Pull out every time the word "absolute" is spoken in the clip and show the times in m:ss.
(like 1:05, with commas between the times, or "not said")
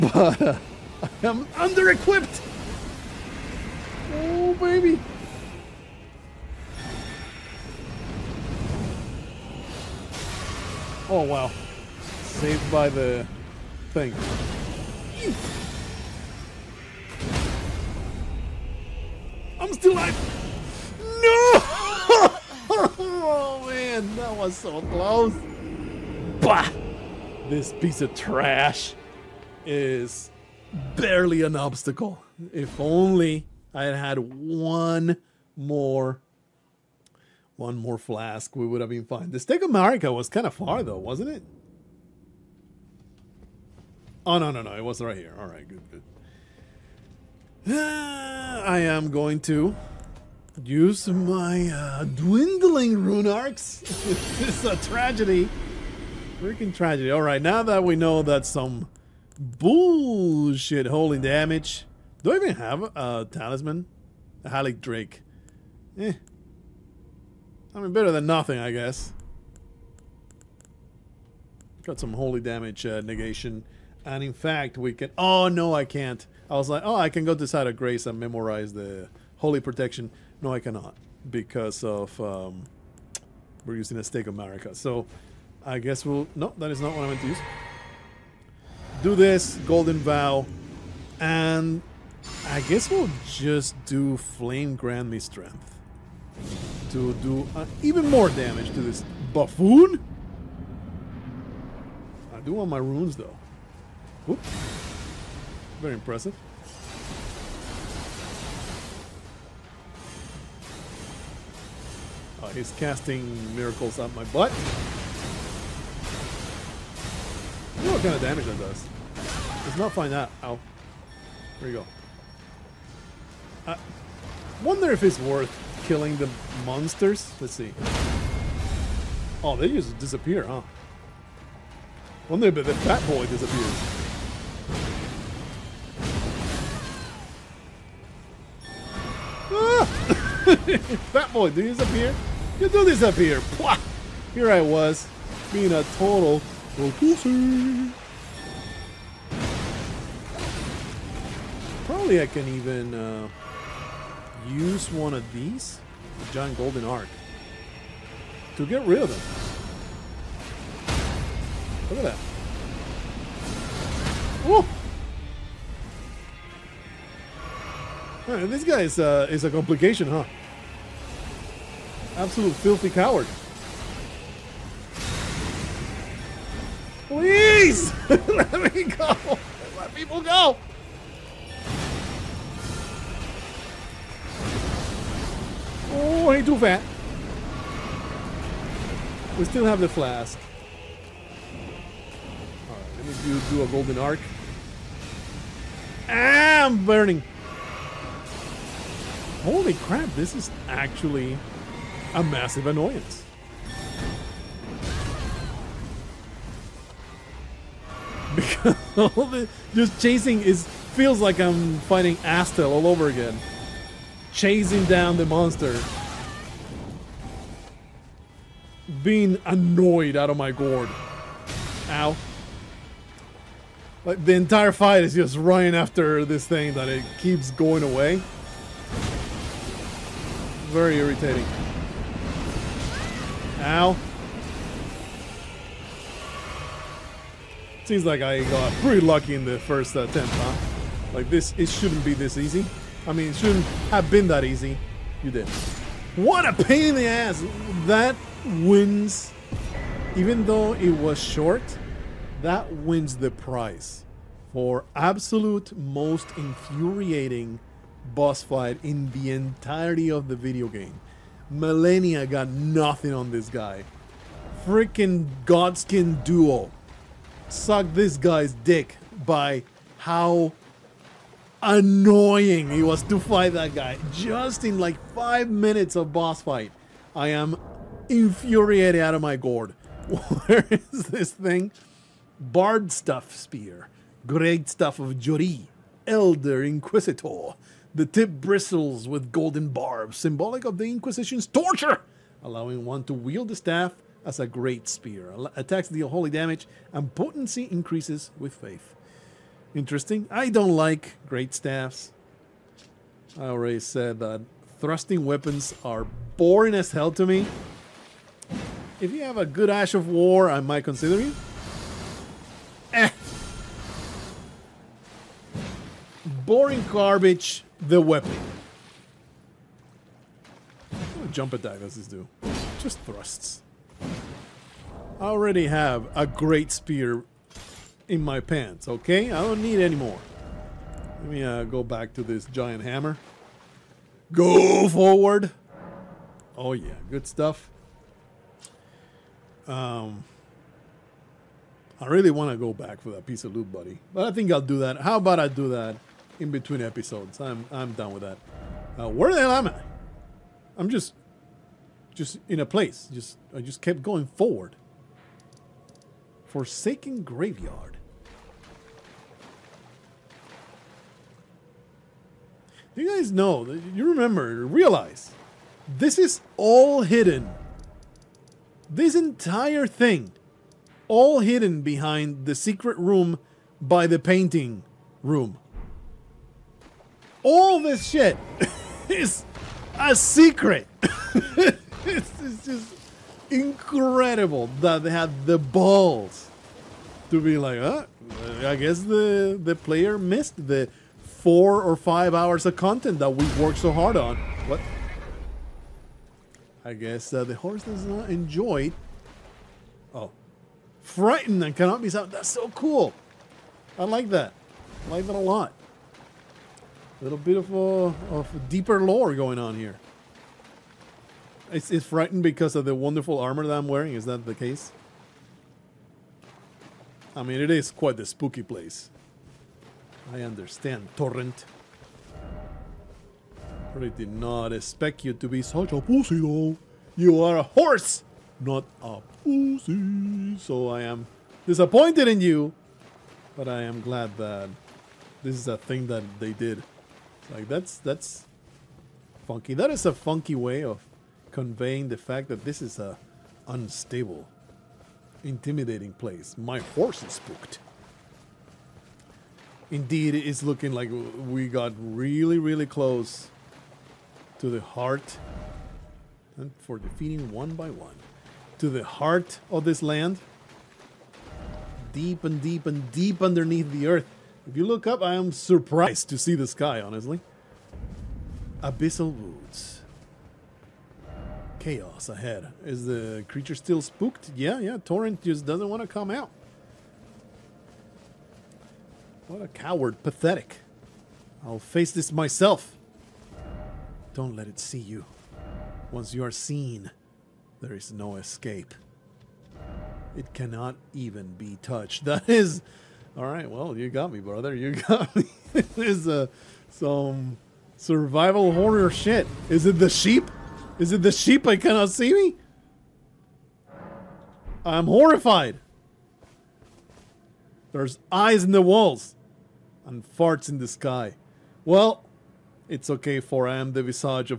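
2:52, 4:14.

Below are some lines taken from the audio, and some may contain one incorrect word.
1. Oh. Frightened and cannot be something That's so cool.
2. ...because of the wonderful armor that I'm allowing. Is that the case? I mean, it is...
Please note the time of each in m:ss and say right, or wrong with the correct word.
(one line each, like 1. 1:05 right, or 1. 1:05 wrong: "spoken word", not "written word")
1. 6:40 right
2. 6:52 wrong: "wearing", not "allowing".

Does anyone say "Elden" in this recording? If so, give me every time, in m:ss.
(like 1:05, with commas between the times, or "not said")
4:46.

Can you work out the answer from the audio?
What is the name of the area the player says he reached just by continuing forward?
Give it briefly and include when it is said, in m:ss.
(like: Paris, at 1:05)
Forsaken Graveyard, at 5:56.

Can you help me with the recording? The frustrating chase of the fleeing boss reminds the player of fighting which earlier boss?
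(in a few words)
Astel.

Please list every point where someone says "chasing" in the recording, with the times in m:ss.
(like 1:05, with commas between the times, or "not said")
3:30, 3:34.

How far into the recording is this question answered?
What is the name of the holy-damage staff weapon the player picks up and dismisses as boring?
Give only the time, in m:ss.
4:44.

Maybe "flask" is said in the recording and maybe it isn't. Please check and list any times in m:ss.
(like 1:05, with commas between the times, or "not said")
0:37, 3:09.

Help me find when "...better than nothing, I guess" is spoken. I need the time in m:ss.
1:07.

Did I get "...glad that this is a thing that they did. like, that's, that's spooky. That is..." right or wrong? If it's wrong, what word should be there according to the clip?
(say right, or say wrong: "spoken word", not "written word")
wrong: "funky", not "spooky".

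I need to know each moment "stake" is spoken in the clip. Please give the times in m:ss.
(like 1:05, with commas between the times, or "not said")
0:39, 1:24.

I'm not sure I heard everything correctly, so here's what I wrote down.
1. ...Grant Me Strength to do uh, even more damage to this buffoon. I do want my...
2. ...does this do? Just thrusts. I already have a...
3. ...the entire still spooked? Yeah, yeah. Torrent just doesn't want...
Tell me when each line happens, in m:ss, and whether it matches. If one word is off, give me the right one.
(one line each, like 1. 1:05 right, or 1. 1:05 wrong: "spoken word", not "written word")
1. 1:34 right
2. 5:21 right
3. 7:53 wrong: "creature", not "entire".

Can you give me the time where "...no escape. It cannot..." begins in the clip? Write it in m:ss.
8:08.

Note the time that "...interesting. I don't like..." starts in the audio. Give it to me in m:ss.
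4:59.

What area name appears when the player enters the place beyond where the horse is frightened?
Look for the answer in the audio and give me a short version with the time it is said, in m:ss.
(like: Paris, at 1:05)
Abyssal Woods, at 7:48.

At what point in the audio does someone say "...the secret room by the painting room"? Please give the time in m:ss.
6:12.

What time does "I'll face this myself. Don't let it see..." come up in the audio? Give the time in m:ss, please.
8:01.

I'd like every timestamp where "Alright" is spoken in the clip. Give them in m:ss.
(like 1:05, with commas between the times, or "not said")
3:12, 8:13.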